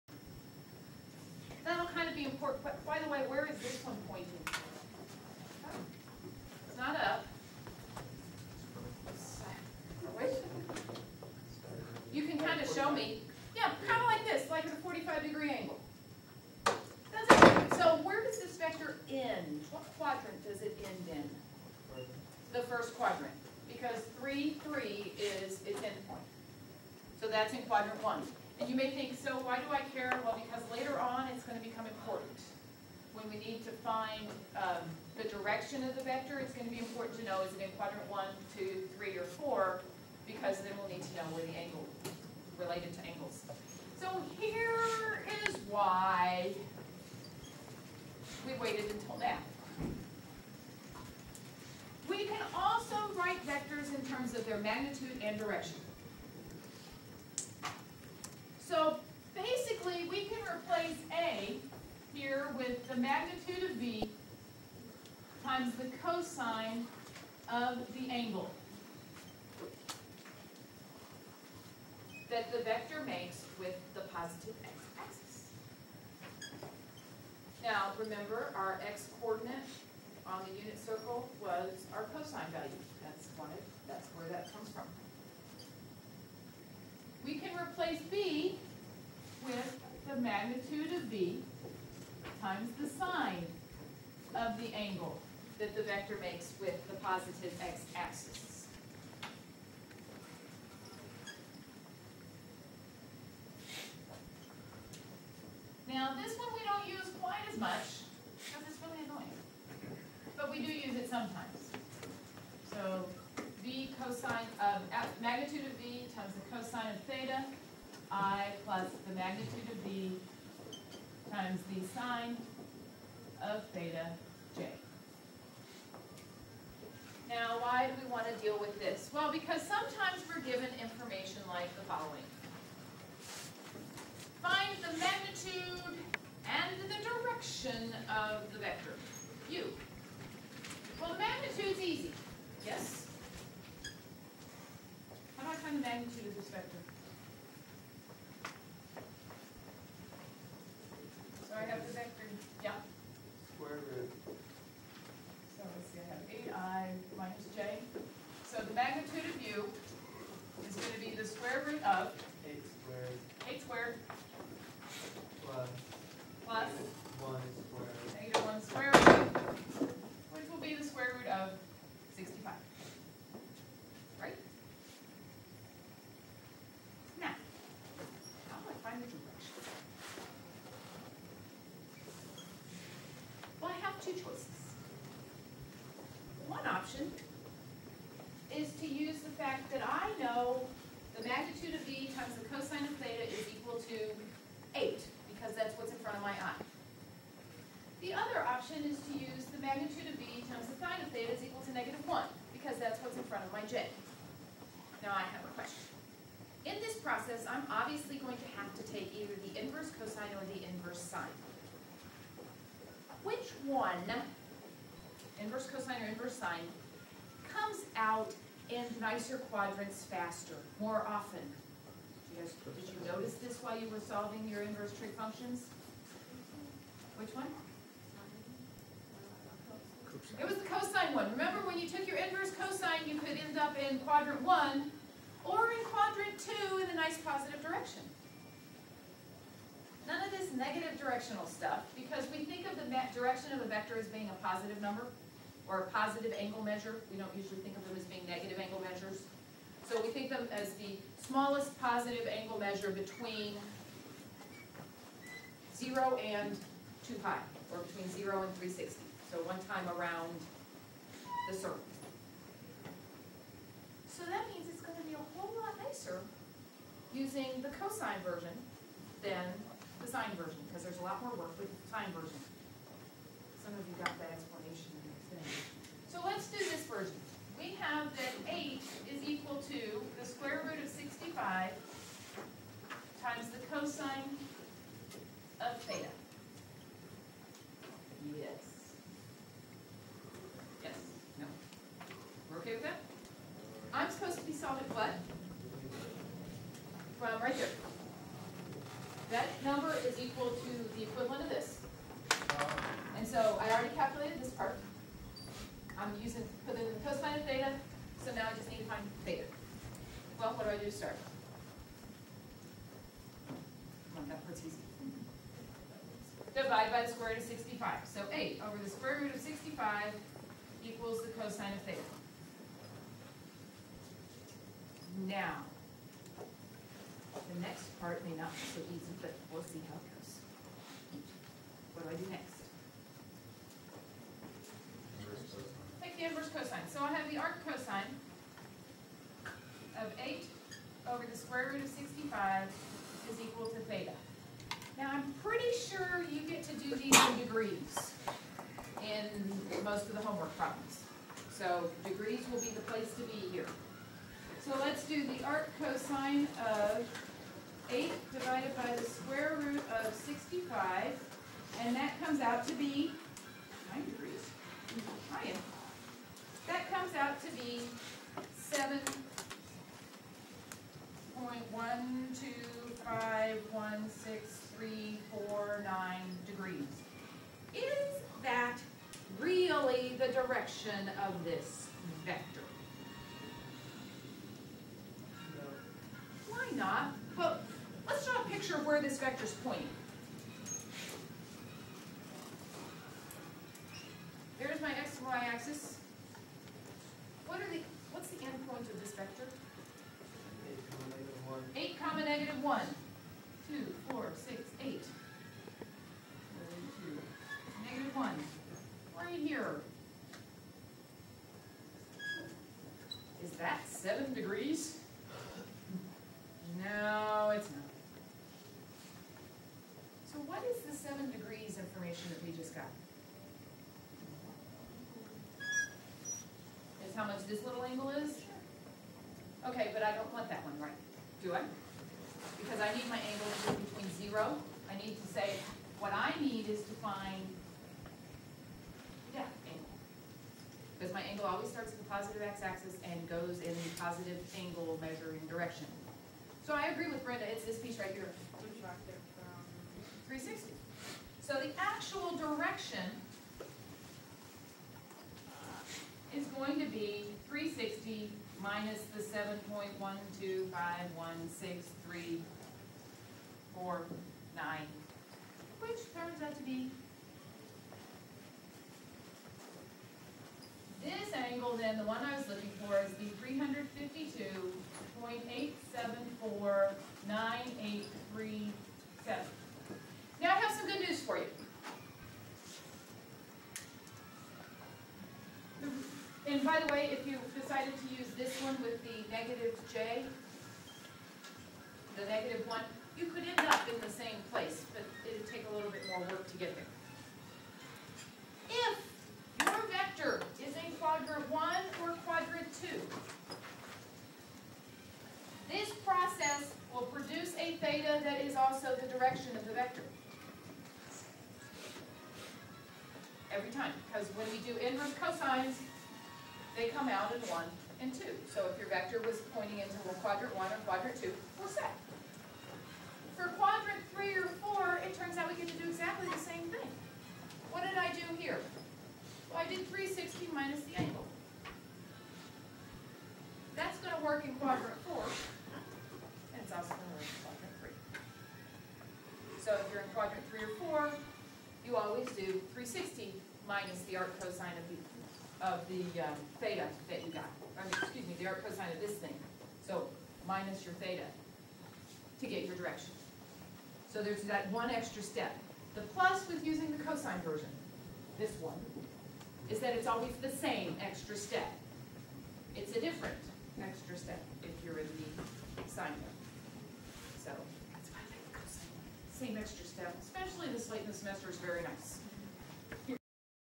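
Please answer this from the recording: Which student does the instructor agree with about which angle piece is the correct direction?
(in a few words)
Brenda.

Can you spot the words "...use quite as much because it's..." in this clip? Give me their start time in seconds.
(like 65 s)
106 s.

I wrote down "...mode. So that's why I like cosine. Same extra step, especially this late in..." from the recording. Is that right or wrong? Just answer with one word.
right.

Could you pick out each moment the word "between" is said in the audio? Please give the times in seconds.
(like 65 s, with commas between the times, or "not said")
252 s, 257 s, 433 s.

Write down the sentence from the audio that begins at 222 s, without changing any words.
Did you, guys, did you notice this while you were solving your inverse trig functions?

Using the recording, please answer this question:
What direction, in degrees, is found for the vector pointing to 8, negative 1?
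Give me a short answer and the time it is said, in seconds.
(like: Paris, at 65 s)
352.874983, at 473 s.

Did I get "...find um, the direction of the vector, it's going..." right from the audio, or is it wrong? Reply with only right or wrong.
right.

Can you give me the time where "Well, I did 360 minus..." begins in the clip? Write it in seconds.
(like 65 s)
529 s.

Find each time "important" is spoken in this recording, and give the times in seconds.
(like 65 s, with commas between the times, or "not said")
2 s, 31 s, 36 s.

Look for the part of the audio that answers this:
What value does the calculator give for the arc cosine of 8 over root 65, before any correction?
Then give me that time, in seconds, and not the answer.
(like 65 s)
368 s.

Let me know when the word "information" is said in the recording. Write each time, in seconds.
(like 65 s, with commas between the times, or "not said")
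130 s, 422 s.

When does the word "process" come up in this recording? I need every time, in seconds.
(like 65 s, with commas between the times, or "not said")
207 s, 506 s.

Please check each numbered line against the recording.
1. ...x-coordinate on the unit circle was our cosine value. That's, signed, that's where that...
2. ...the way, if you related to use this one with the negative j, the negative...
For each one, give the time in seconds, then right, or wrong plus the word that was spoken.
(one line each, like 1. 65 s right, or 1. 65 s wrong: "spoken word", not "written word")
1. 78 s wrong: "wanted", not "signed"
2. 486 s wrong: "decided", not "related".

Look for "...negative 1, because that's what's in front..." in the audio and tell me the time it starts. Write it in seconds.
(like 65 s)
201 s.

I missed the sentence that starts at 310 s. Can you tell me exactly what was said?
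Well, what do I do to start?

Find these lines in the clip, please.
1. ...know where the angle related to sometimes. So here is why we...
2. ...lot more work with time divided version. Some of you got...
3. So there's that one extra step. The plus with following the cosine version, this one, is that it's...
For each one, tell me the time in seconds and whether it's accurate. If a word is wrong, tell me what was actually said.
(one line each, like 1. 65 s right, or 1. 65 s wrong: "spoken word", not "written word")
1. 41 s wrong: "angles", not "sometimes"
2. 271 s wrong: "signed", not "divided"
3. 554 s wrong: "using", not "following".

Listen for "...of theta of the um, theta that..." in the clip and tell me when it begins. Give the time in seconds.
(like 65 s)
544 s.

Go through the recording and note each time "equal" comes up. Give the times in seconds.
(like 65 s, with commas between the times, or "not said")
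193 s, 201 s, 300 s, 320 s, 343 s.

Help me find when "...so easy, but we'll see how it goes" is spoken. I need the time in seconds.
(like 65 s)
328 s.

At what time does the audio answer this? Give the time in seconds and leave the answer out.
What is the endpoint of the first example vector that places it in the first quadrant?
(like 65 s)
24 s.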